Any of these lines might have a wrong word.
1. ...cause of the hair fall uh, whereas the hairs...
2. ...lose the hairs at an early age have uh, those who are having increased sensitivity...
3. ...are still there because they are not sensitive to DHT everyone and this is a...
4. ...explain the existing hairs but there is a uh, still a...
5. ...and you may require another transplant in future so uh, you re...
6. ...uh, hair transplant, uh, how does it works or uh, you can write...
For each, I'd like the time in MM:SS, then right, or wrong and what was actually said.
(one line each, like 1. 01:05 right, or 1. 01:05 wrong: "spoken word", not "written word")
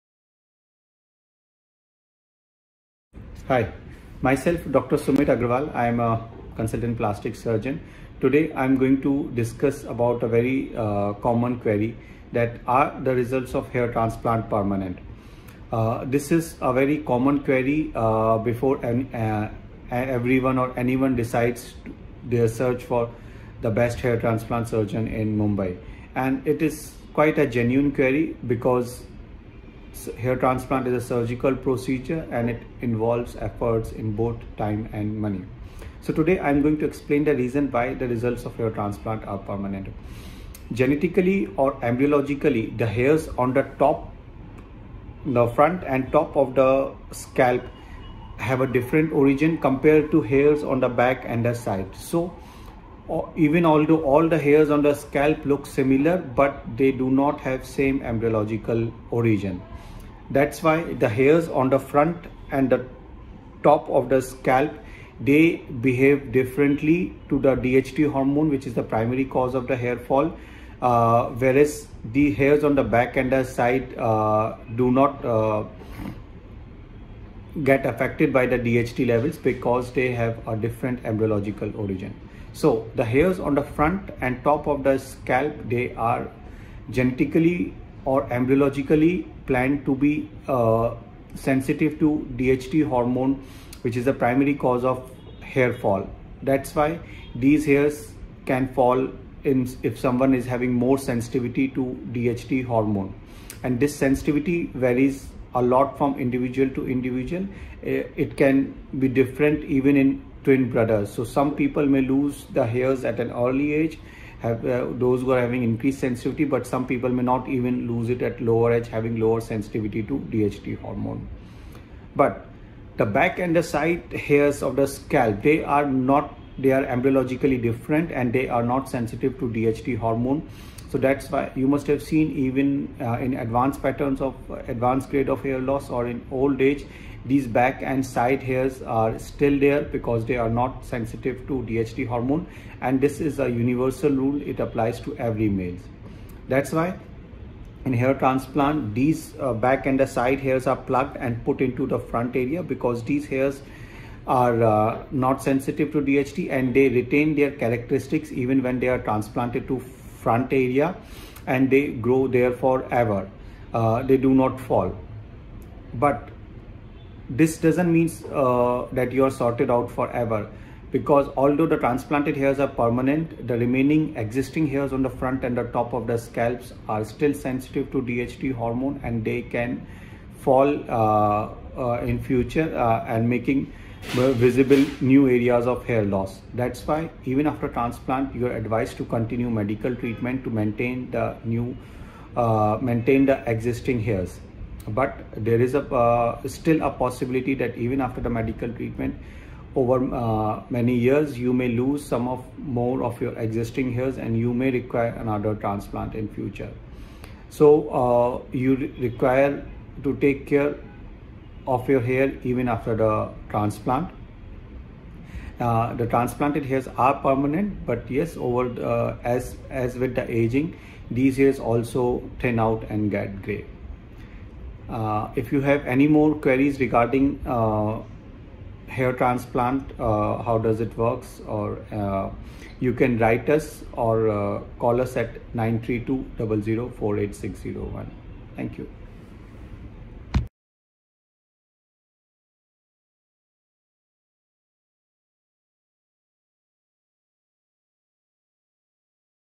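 1. 01:09 right
2. 01:52 right
3. 02:18 wrong: "hormone", not "everyone"
4. 03:12 wrong: "maintain", not "explain"
5. 03:24 right
6. 03:47 right.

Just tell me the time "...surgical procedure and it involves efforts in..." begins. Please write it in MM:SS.
00:31.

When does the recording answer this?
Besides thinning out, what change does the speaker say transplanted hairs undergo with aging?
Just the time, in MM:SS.
03:43.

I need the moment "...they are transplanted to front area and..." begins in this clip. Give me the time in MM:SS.
02:38.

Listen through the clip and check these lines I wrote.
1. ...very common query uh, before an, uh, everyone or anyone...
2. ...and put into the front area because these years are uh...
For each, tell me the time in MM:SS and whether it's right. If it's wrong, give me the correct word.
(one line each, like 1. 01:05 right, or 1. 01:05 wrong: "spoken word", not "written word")
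1. 00:16 right
2. 02:31 wrong: "hairs", not "years".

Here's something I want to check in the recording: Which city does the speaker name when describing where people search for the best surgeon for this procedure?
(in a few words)
Mumbai.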